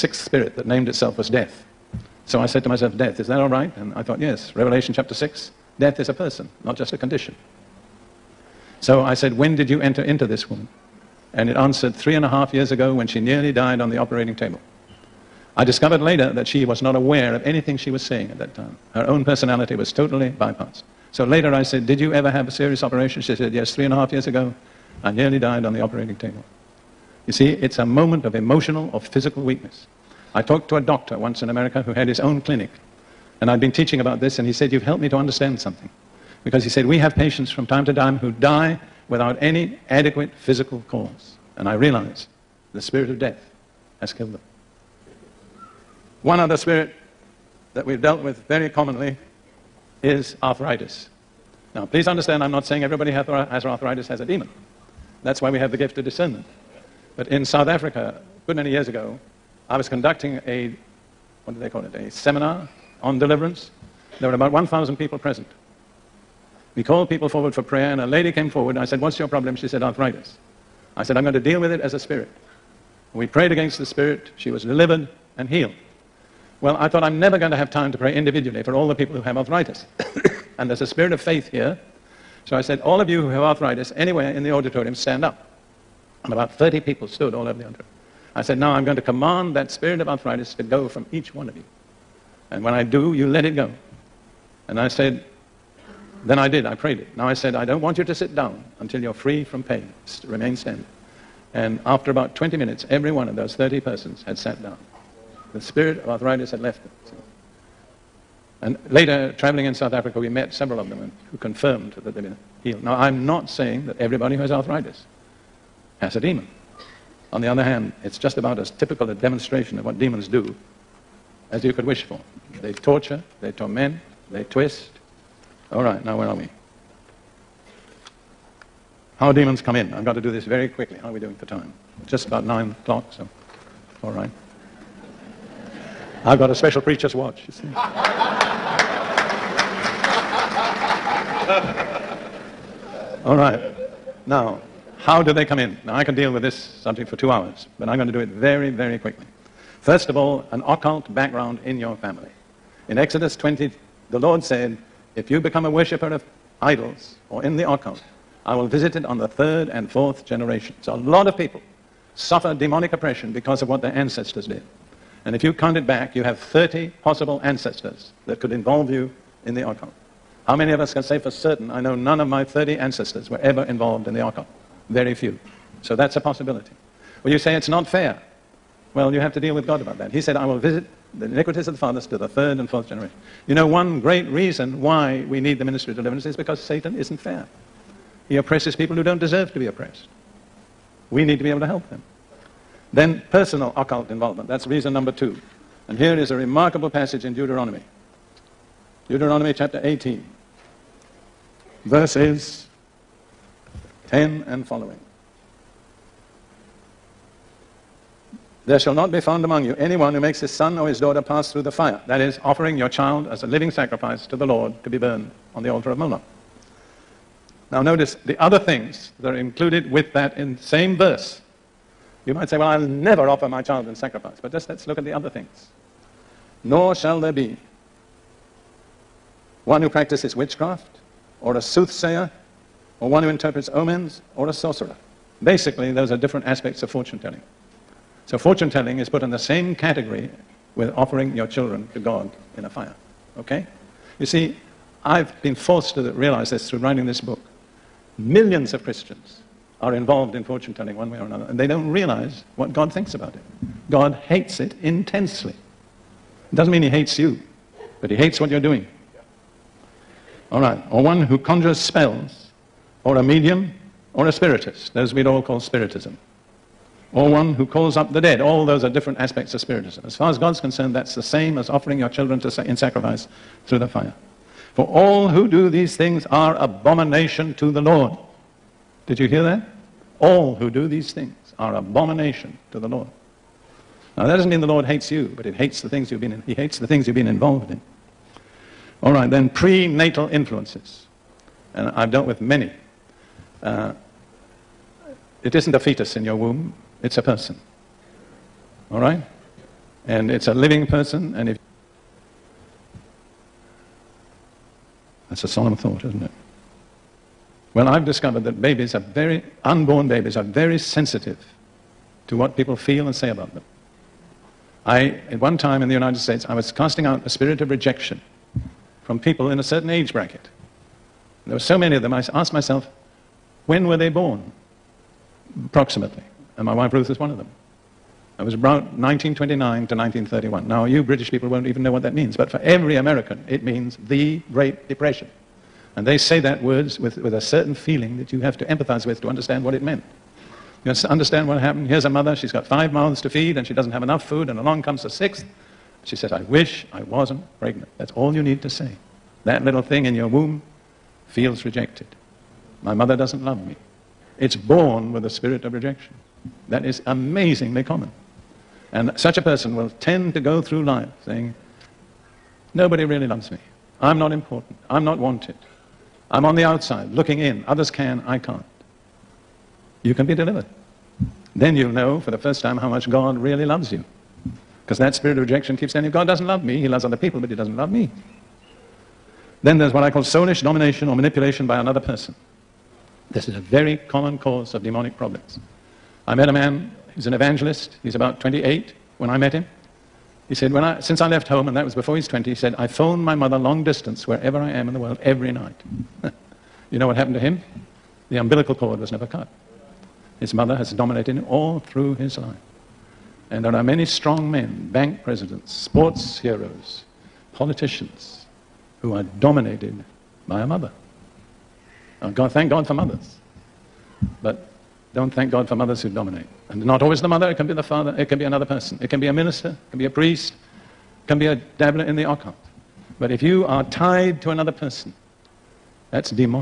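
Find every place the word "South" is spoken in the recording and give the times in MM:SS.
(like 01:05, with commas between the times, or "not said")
00:57, 01:49.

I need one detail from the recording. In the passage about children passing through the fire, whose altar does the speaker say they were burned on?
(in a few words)
Moloch.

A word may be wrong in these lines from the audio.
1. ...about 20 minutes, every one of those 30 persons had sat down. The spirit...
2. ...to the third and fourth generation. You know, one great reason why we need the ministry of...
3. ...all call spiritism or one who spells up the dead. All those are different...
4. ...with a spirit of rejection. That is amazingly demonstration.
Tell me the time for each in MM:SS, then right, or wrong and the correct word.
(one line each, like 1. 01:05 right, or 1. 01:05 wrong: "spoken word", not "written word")
1. 01:42 right
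2. 03:02 right
3. 04:25 wrong: "calls", not "spells"
4. 05:55 wrong: "common", not "demonstration".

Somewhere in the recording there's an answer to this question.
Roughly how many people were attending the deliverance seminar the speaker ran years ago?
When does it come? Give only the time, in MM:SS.
01:04.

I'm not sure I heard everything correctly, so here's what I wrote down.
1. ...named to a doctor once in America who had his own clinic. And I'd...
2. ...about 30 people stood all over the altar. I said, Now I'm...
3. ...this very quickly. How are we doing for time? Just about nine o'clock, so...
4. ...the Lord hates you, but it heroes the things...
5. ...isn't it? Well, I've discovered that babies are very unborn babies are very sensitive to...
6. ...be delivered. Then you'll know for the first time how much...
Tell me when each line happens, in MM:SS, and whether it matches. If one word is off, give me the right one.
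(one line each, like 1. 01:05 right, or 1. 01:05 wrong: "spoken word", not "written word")
1. 00:30 wrong: "talked", not "named"
2. 01:26 right
3. 02:10 right
4. 04:44 wrong: "hates", not "heroes"
5. 05:06 right
6. 06:10 right.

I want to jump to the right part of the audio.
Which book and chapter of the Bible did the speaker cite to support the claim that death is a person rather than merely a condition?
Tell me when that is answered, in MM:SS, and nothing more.
00:04.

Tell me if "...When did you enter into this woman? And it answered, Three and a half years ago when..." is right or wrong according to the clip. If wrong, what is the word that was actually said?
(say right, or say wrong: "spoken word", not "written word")
right.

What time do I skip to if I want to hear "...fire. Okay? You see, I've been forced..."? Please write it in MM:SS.
04:02.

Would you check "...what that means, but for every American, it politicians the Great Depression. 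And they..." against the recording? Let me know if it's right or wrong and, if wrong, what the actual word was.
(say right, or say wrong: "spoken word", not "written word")
wrong: "means", not "politicians".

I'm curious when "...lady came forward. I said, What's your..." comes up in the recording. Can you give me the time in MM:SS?
01:08.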